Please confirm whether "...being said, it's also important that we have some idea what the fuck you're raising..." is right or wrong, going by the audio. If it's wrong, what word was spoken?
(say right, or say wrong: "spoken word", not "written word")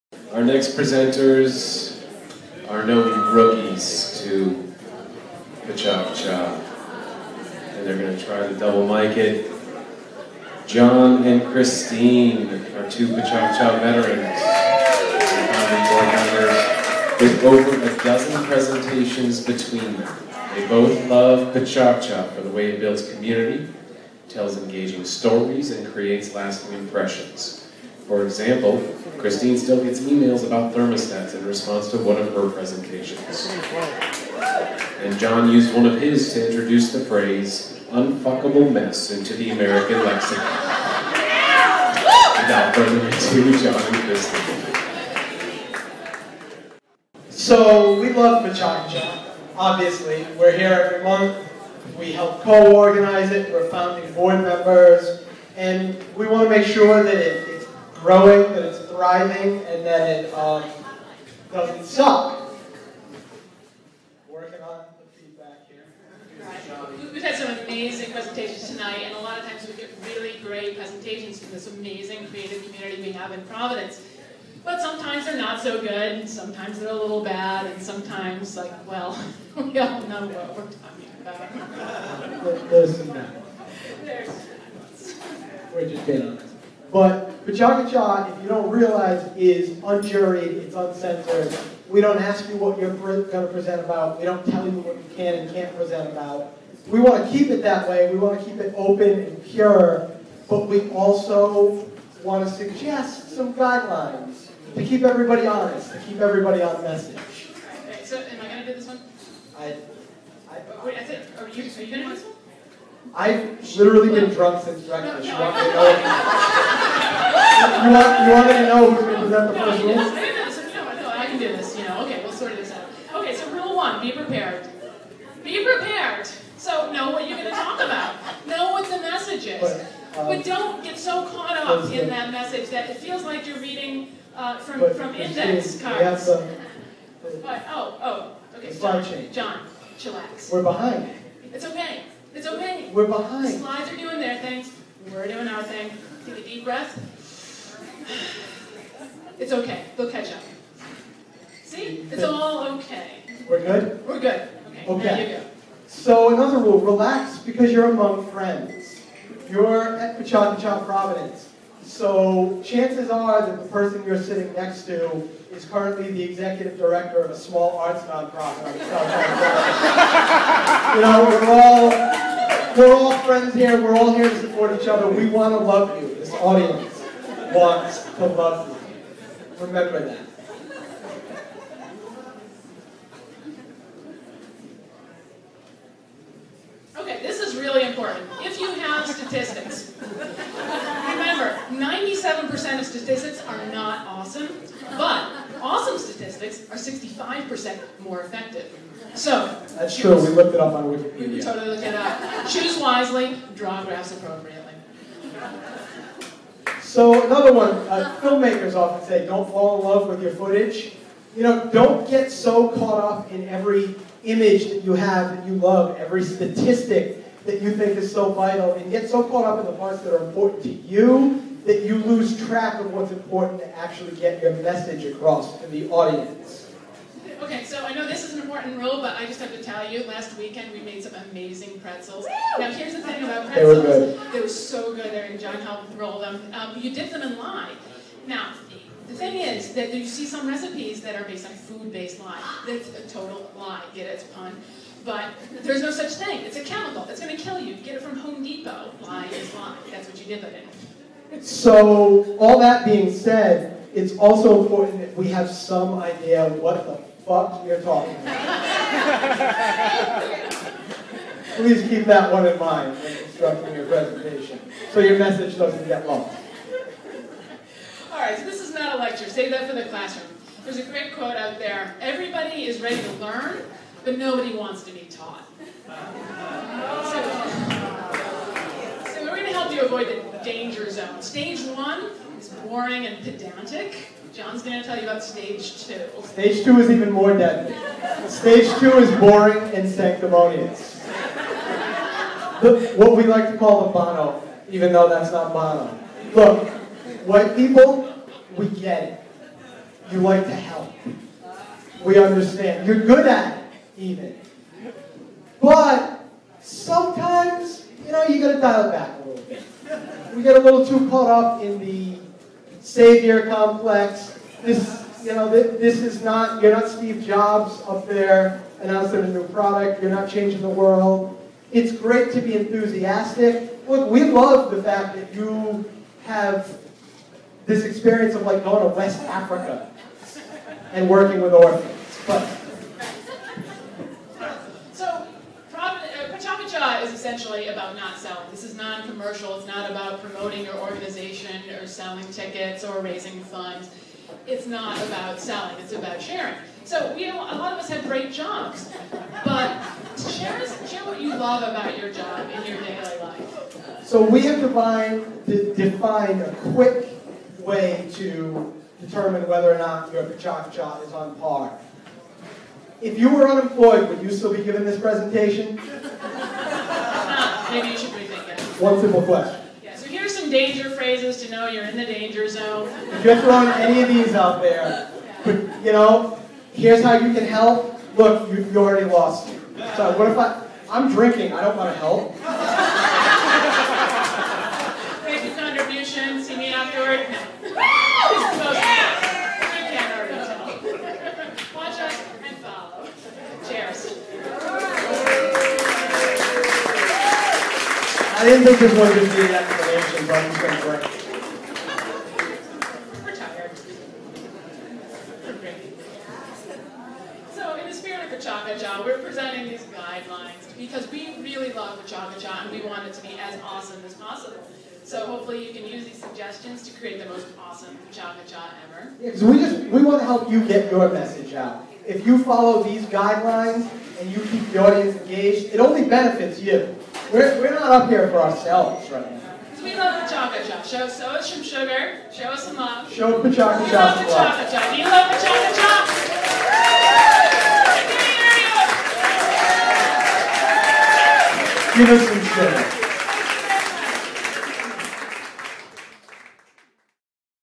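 wrong: "talking", not "raising".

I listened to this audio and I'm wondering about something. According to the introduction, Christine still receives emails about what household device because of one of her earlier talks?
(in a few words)
thermostats.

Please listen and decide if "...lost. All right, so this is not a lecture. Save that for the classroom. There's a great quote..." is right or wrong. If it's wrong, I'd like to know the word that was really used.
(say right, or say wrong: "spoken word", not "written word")
right.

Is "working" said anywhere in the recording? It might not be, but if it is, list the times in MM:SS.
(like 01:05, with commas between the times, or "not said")
01:04, 05:31.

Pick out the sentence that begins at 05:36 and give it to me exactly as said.
cha is essentially about not selling.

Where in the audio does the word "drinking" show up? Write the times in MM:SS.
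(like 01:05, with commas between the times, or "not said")
06:21.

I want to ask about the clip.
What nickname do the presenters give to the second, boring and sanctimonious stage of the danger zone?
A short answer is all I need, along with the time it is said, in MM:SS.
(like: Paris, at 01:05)
the Bono, at 04:53.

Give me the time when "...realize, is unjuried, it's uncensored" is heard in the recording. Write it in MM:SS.
01:28.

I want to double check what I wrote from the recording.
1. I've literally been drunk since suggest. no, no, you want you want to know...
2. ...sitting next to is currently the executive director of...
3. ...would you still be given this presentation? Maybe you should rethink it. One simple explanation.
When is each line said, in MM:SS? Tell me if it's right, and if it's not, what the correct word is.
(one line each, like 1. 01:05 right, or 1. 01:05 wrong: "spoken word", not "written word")
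1. 01:53 wrong: "breakfast", not "suggest"
2. 02:44 right
3. 06:04 wrong: "question", not "explanation".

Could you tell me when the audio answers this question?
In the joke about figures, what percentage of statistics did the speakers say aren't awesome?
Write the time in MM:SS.
03:11.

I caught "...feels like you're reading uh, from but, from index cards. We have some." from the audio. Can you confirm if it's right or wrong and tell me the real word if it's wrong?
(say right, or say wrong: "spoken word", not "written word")
right.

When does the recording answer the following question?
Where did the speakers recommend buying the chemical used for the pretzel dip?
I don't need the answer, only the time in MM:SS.
04:08.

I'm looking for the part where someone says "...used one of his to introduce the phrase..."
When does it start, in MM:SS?
00:35.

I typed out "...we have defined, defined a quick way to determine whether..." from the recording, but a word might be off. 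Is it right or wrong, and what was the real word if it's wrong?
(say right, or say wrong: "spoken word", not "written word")
right.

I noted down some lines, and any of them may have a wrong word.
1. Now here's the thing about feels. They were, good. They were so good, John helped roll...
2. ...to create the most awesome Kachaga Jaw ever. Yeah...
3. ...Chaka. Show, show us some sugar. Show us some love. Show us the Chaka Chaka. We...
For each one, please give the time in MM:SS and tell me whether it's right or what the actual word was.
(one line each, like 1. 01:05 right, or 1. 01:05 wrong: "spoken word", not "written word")
1. 03:52 wrong: "pretzels", not "feels"
2. 06:56 right
3. 07:10 right.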